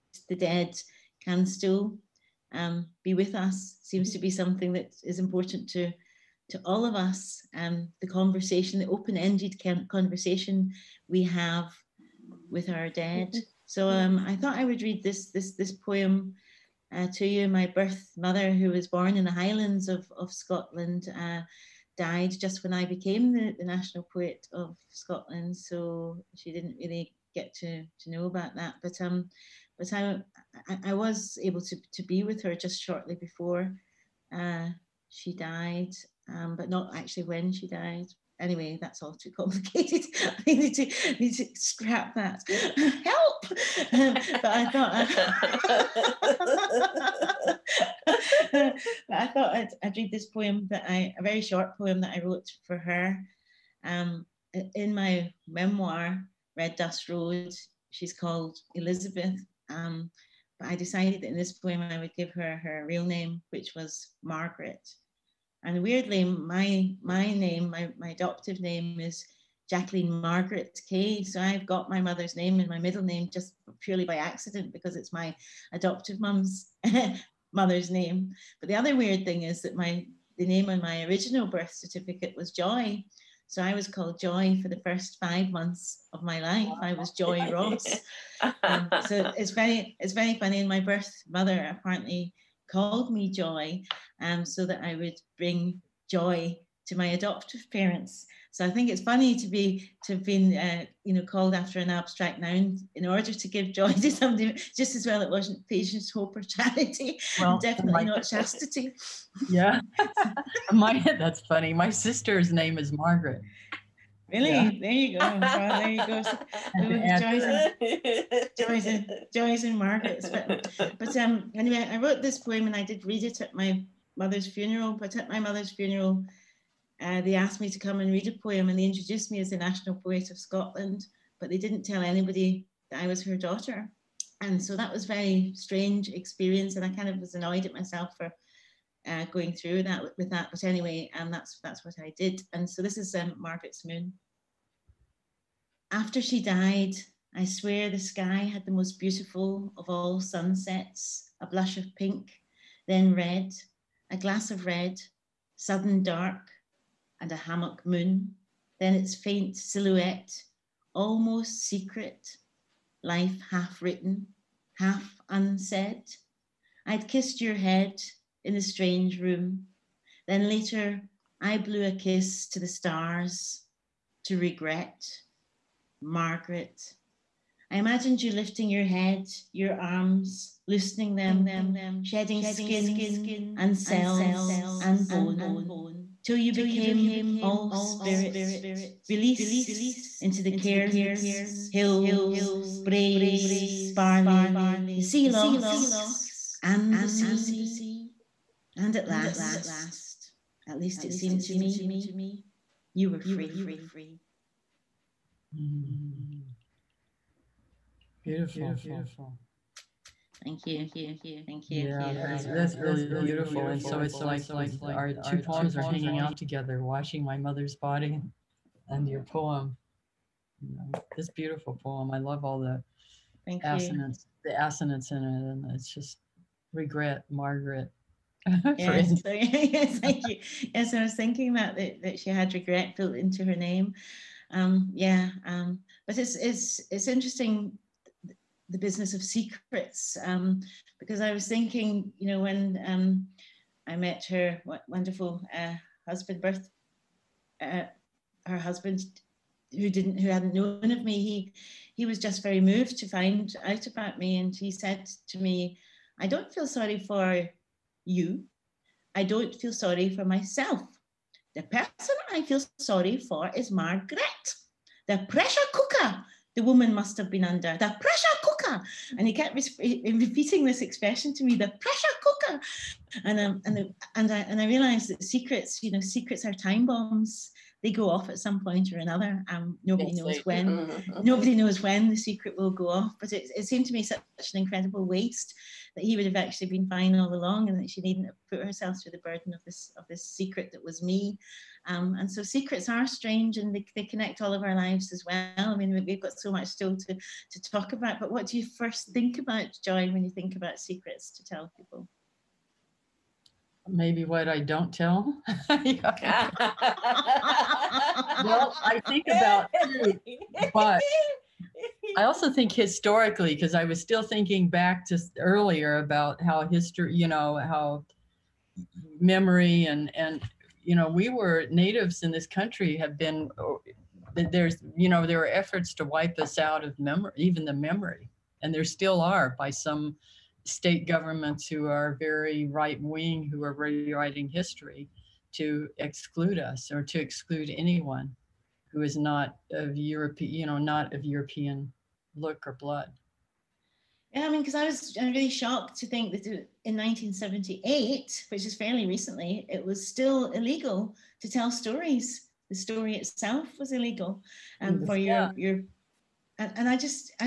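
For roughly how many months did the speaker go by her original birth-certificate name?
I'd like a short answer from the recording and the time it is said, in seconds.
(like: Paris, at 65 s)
5, at 85 s.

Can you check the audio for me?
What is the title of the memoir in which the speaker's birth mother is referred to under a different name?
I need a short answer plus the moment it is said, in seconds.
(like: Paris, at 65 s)
Red Dust Road, at 56 s.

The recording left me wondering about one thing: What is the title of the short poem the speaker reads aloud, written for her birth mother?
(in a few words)
Margaret's Moon.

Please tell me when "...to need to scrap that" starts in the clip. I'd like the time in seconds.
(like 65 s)
40 s.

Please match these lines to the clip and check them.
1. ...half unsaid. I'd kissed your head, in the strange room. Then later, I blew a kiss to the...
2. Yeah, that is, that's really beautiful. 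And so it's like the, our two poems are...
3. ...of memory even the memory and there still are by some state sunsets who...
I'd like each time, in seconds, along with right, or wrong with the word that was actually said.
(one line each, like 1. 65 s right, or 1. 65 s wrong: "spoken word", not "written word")
1. 164 s right
2. 211 s right
3. 326 s wrong: "governments", not "sunsets".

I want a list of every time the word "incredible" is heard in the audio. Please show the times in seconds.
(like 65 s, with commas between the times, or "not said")
284 s.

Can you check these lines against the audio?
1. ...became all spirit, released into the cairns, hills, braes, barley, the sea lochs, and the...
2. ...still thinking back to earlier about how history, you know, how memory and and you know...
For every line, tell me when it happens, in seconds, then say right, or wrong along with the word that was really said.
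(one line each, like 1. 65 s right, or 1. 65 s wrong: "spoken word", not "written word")
1. 186 s right
2. 314 s right.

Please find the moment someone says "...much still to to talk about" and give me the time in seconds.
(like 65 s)
296 s.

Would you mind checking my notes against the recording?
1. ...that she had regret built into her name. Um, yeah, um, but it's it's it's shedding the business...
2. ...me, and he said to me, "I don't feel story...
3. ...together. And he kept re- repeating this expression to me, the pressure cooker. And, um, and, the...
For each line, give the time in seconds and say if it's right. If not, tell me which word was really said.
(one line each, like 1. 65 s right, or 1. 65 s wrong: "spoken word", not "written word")
1. 232 s wrong: "interesting", not "shedding"
2. 254 s wrong: "sorry", not "story"
3. 268 s wrong: "cooker", not "together".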